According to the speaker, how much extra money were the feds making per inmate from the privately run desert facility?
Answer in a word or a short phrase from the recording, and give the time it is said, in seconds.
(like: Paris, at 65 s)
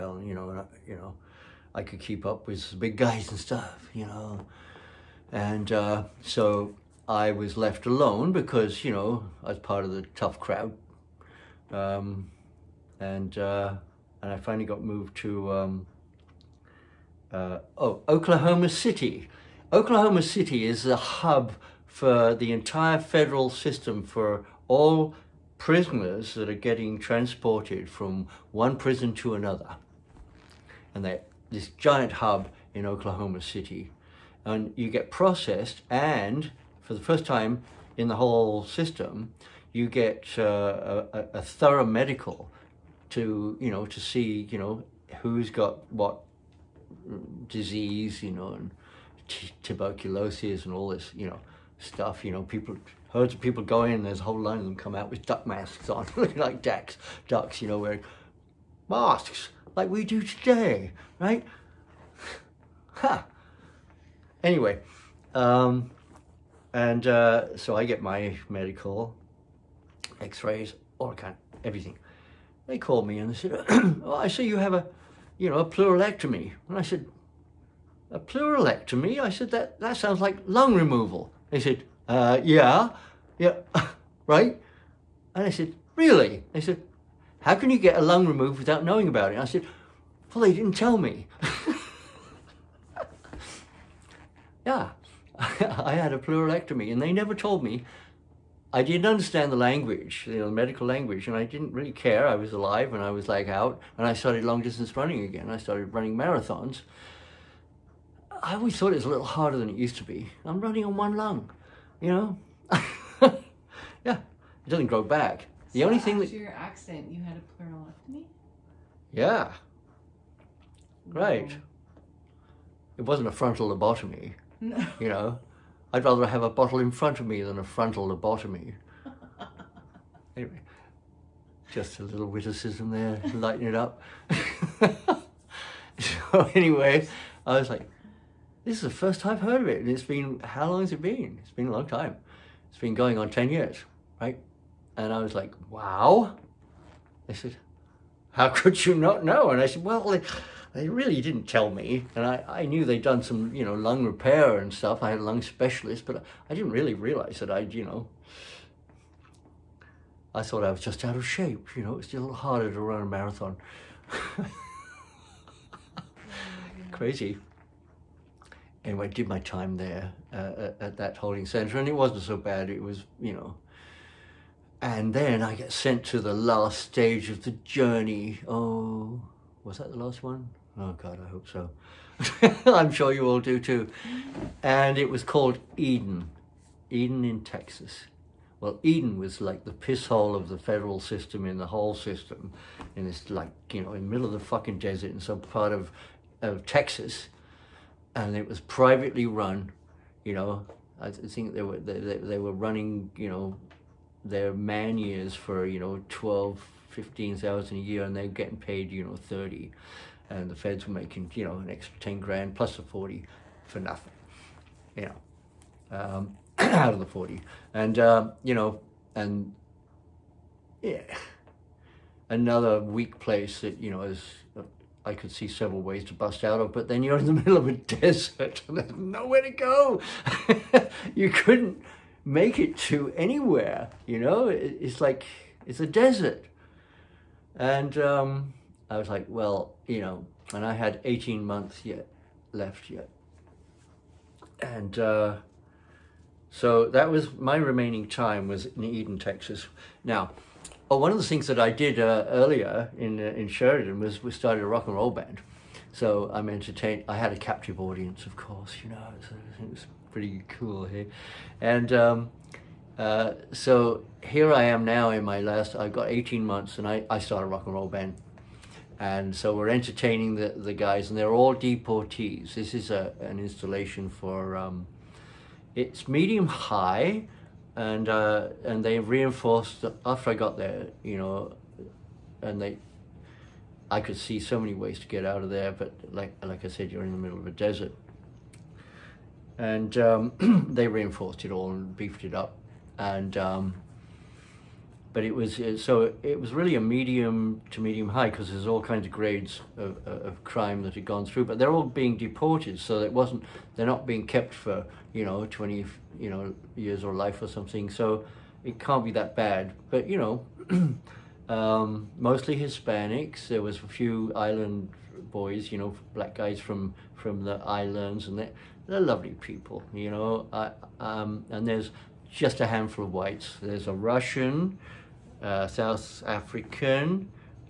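10 grand, at 211 s.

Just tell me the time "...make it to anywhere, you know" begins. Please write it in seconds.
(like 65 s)
232 s.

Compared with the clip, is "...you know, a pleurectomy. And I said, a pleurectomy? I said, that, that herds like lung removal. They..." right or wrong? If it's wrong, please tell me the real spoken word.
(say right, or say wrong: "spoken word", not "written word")
wrong: "sounds", not "herds".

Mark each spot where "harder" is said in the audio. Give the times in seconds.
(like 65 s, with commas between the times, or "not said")
109 s, 162 s.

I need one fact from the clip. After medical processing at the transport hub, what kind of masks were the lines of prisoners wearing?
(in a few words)
duck masks.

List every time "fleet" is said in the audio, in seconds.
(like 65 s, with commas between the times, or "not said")
not said.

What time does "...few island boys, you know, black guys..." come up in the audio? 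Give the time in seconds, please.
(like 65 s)
313 s.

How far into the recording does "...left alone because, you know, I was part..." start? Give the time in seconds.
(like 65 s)
7 s.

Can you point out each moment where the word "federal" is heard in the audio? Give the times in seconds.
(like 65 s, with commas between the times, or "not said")
22 s, 190 s.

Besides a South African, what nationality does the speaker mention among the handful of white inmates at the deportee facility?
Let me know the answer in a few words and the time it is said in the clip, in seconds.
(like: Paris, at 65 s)
Russian, at 323 s.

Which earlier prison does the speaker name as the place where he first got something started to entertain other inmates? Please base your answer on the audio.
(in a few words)
Sheridan.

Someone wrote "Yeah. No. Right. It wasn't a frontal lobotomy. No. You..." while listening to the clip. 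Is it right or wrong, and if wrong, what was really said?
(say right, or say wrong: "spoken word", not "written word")
right.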